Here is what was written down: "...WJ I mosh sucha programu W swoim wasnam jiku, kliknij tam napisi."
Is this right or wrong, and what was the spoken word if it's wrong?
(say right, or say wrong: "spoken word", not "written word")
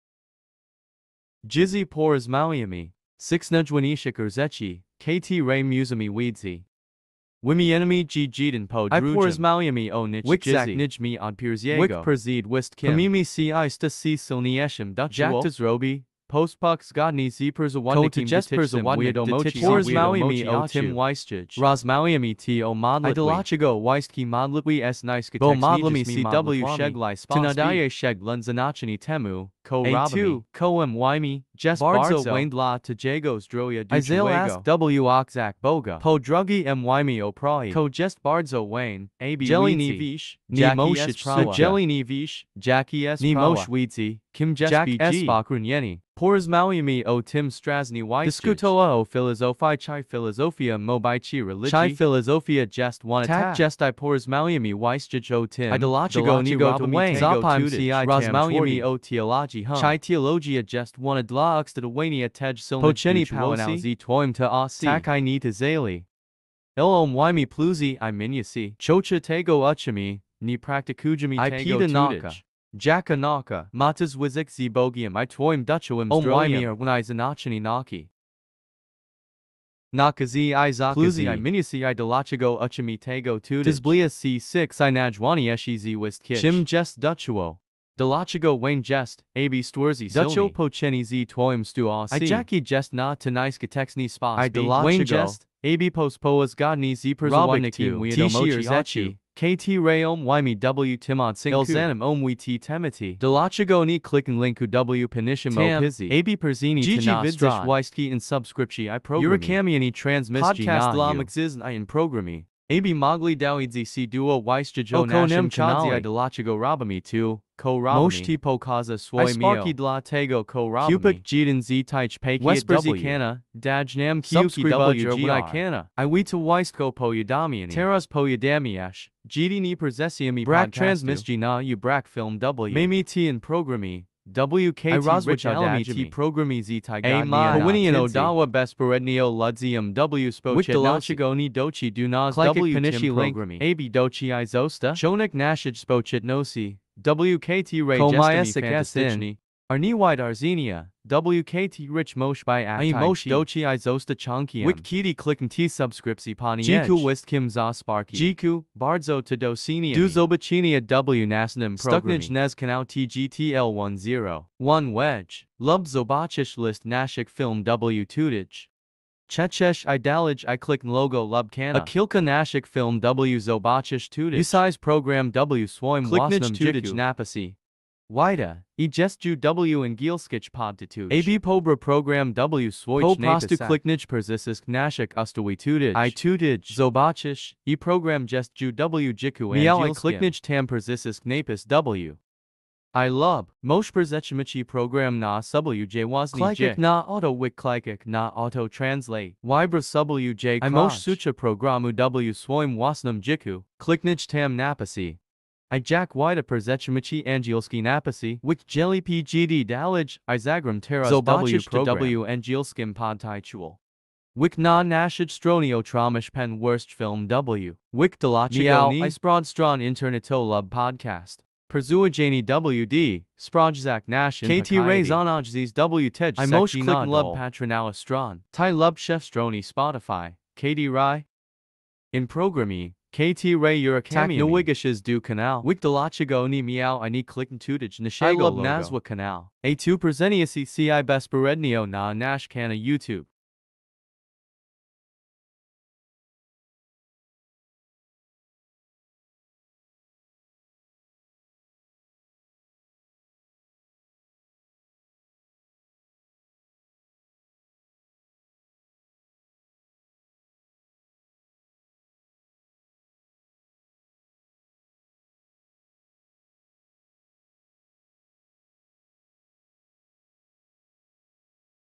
right.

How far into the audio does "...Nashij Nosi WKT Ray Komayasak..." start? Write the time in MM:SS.
02:25.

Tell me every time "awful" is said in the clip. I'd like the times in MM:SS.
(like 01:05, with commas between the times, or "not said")
not said.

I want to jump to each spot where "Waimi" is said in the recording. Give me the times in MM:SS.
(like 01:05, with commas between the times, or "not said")
01:07, 01:16.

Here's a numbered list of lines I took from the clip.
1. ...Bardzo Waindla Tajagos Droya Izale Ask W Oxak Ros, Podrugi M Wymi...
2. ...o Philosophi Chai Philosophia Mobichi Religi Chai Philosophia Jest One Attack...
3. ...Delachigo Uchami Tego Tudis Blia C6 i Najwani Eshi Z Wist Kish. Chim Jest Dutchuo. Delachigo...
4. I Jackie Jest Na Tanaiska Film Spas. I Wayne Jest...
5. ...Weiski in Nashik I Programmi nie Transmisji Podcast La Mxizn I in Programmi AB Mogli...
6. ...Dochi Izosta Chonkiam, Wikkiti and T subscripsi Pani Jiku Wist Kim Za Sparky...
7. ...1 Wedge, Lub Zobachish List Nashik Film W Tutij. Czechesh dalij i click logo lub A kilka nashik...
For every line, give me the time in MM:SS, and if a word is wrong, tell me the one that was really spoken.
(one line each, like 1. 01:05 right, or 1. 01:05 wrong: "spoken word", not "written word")
1. 00:31 wrong: "Boga", not "Ros"
2. 00:48 right
3. 01:21 right
4. 01:32 wrong: "Texni", not "Film"
5. 01:47 wrong: "Subscription", not "Nashik"
6. 02:33 right
7. 02:44 wrong: "idalij", not "dalij".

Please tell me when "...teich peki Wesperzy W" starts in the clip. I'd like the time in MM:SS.
02:01.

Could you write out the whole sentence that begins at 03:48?
Tai Lub Chef Stroni Spotify, KD Rai.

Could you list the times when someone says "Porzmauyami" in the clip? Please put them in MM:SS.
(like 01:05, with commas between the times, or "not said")
00:46, 00:53.